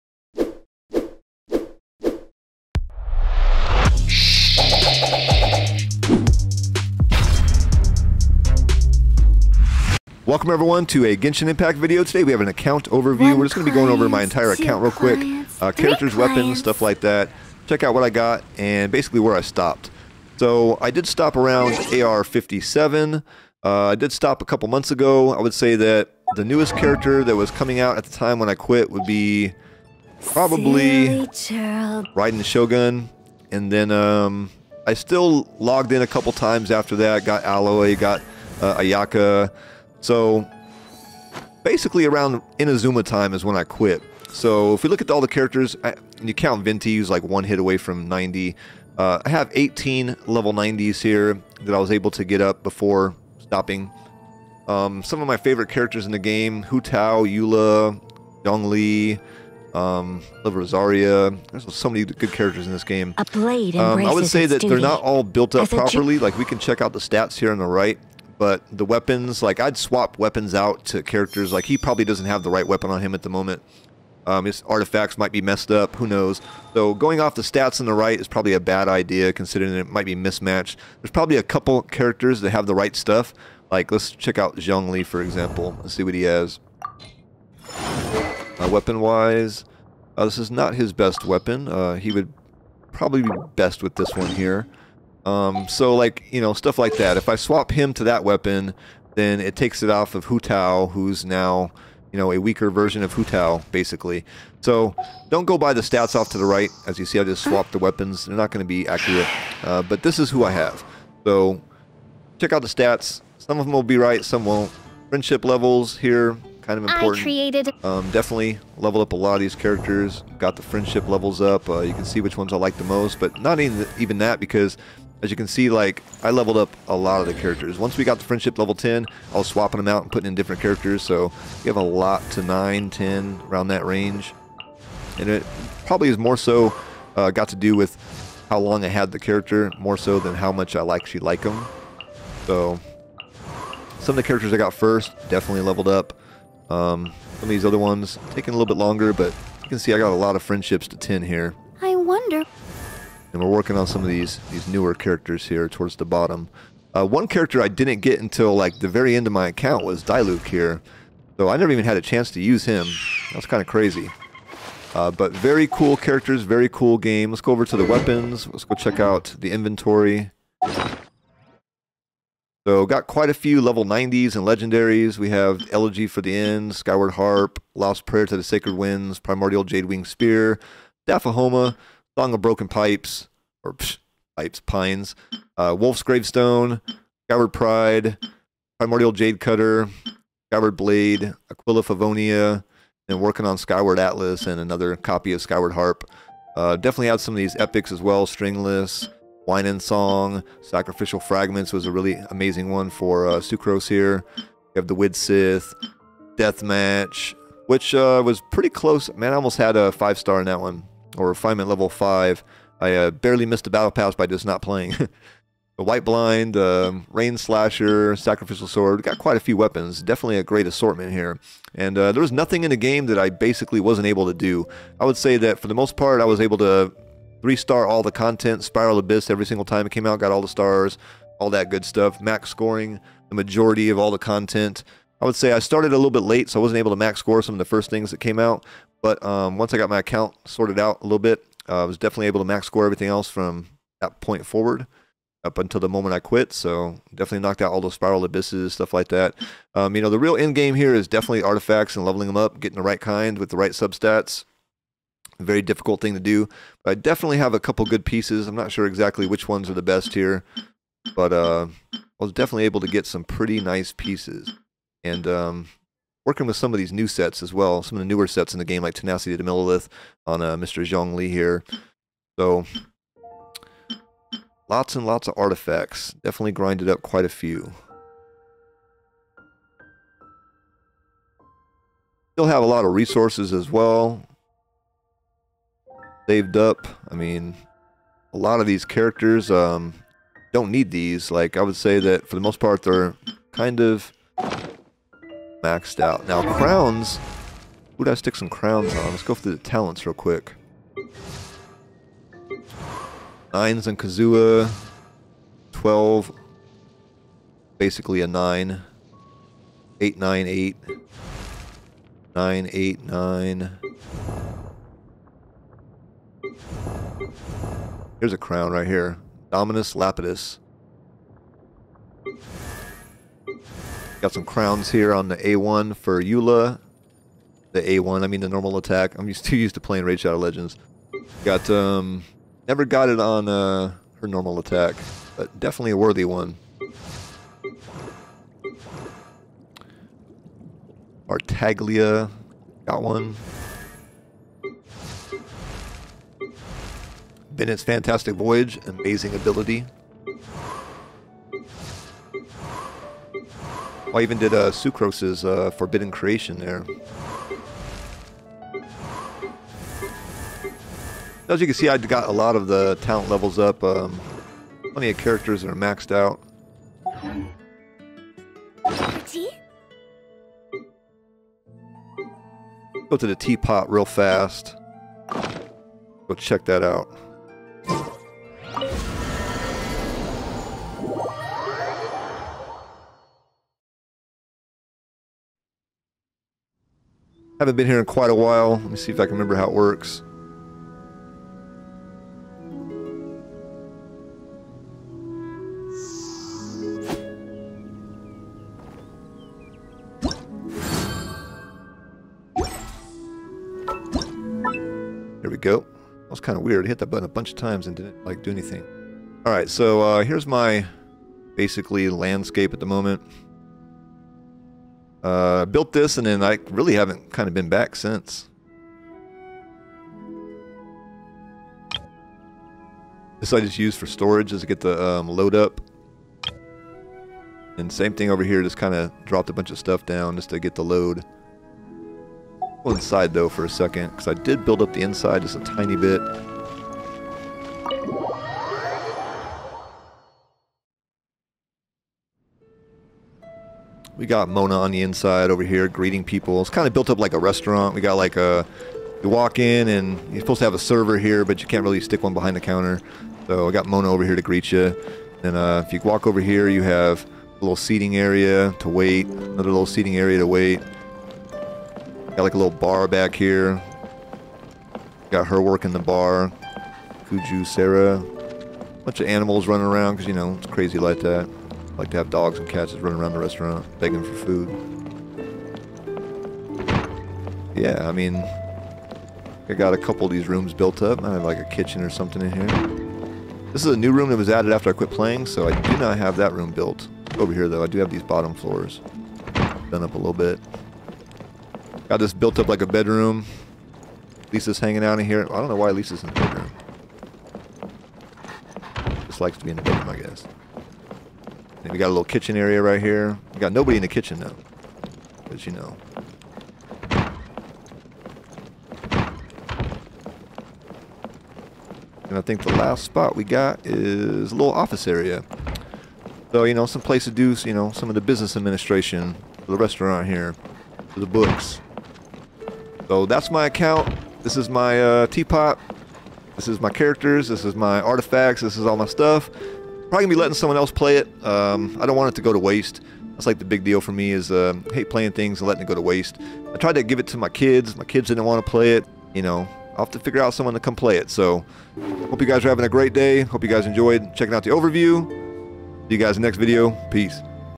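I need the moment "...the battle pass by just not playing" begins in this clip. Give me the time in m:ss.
3:33.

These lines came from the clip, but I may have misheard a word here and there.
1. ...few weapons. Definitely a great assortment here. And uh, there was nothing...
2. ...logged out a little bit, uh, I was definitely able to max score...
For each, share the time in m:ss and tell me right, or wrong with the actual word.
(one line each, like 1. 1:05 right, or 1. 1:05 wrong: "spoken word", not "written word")
1. 3:39 right
2. 4:00 wrong: "sorted", not "logged".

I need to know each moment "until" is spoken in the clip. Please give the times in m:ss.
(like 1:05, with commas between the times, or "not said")
2:38, 4:05.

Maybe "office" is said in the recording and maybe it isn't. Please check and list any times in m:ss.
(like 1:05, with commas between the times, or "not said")
8:34.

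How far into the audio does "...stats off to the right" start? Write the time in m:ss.
1:45.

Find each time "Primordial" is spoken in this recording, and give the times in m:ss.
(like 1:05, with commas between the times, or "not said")
2:59, 3:08.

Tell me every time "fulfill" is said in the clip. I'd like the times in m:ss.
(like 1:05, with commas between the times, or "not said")
not said.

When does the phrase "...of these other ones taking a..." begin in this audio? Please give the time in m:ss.
2:27.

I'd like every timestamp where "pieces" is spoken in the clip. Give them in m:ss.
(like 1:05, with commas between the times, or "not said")
4:18, 4:23.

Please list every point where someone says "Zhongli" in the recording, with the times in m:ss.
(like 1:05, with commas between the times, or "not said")
1:24, 4:30.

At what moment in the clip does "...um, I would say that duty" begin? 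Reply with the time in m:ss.
1:03.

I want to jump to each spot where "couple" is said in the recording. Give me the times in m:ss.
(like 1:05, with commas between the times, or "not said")
0:24, 0:36, 1:21, 4:17, 7:59.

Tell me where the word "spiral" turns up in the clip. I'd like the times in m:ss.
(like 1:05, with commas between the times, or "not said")
3:48, 4:07.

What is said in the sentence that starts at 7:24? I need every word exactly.
We got Mona on the inside over here greeting people.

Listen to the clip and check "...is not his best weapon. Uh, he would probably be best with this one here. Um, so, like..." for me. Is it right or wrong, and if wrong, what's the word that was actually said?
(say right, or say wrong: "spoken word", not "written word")
right.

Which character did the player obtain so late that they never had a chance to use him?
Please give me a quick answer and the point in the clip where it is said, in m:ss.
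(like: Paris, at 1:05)
Diluc, at 2:40.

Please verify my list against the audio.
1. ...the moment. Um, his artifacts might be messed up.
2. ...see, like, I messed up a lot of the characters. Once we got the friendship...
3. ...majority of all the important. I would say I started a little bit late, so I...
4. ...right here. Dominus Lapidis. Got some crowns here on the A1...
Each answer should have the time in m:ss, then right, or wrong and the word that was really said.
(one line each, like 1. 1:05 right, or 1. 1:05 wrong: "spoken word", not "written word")
1. 1:13 right
2. 2:05 wrong: "leveled", not "messed"
3. 3:53 wrong: "content", not "important"
4. 5:18 right.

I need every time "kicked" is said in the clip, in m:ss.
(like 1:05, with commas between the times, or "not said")
not said.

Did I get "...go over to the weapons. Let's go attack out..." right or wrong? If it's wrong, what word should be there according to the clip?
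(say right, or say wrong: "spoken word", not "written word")
wrong: "check", not "attack".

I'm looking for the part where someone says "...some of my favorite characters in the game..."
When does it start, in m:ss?
0:55.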